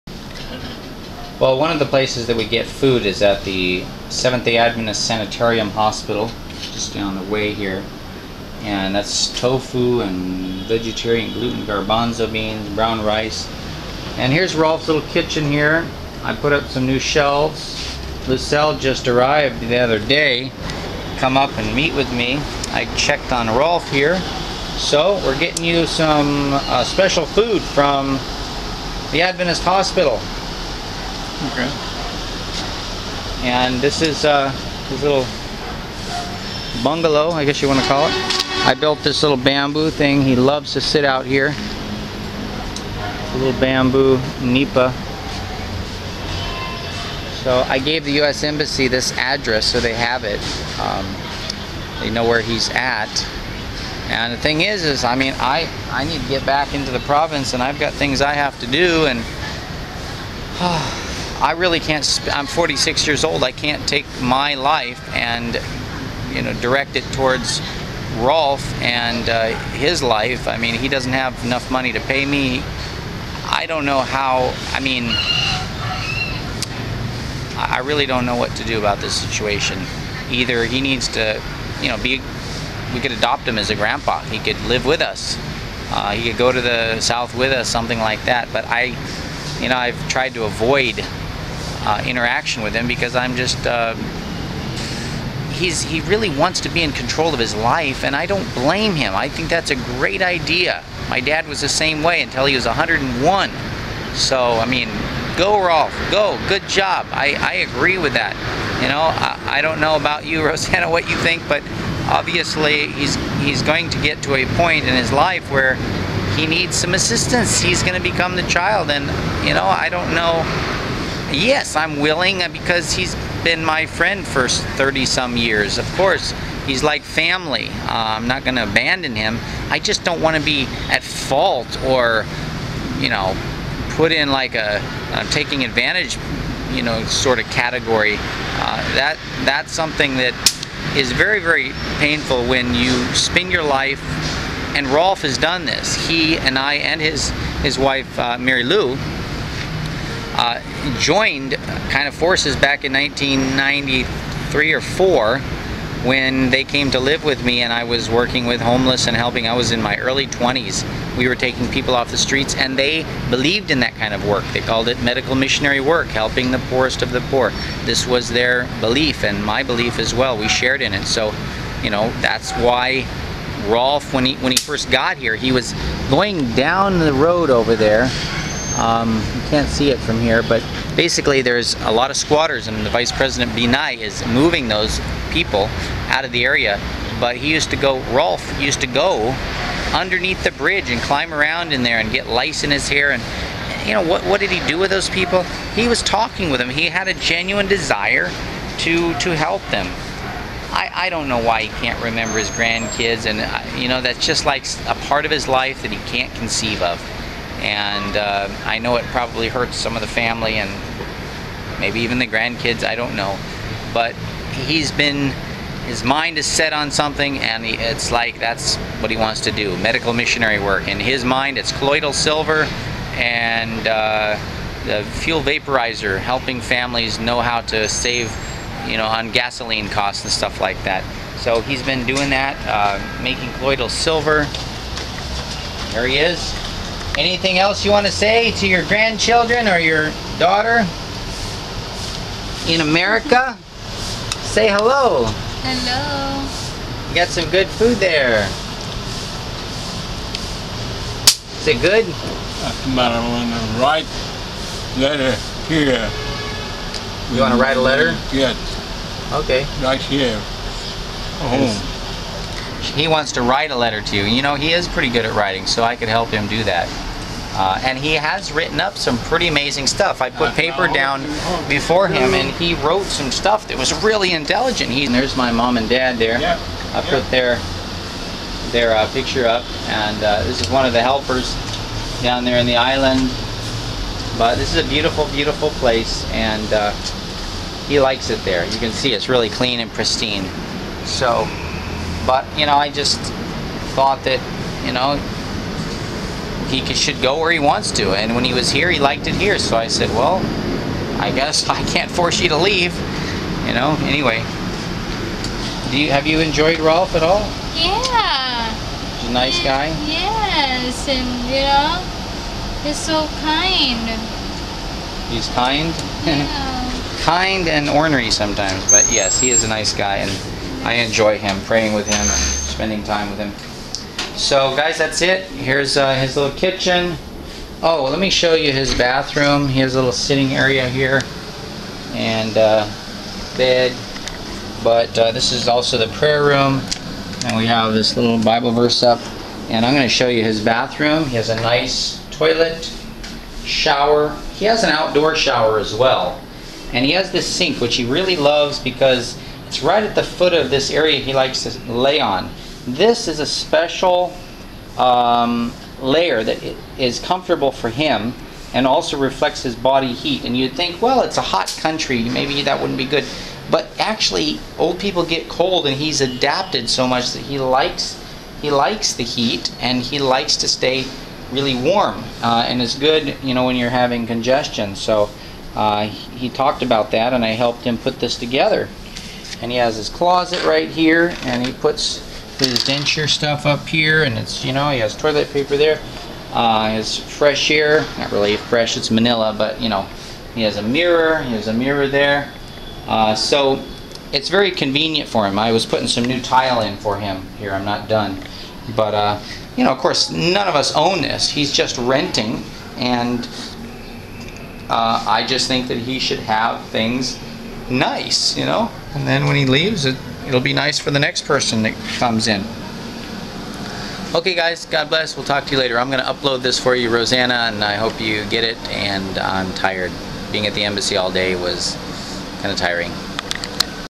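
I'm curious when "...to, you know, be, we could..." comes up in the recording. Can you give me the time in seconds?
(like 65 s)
81 s.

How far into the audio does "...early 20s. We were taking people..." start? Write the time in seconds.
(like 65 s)
159 s.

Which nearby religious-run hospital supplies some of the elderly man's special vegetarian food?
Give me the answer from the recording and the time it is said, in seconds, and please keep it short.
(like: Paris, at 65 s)
Seventh day Adventist Sanitarium Hospital, at 4 s.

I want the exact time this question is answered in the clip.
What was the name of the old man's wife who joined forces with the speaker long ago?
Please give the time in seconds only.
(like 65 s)
148 s.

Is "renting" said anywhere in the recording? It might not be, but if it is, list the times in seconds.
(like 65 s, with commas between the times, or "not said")
401 s.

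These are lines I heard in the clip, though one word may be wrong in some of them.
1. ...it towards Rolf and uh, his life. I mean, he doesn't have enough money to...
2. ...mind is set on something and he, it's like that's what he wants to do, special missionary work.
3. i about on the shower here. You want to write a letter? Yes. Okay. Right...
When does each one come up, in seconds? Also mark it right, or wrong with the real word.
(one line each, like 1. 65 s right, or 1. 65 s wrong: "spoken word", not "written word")
1. 66 s right
2. 216 s wrong: "medical", not "special"
3. 252 s wrong: "letter", not "shower".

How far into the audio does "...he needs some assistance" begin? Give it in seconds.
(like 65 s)
116 s.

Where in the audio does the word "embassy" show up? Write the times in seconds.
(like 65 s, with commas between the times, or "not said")
48 s, 420 s.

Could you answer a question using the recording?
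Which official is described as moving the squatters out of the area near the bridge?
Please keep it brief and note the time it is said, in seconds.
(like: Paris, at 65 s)
Vice President Binay, at 182 s.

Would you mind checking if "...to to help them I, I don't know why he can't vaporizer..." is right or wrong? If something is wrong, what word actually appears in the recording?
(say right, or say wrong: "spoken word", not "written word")
wrong: "remember", not "vaporizer".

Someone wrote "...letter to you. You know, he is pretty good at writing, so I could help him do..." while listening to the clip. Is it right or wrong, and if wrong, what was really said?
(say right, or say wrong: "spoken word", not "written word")
right.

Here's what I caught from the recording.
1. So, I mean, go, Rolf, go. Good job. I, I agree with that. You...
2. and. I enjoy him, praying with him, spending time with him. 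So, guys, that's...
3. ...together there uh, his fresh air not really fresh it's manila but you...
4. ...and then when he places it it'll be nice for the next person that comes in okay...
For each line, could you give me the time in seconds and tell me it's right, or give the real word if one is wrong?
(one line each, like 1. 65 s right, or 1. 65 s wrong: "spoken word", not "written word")
1. 104 s right
2. 320 s right
3. 385 s wrong: "paper", not "together"
4. 409 s wrong: "leaves", not "places".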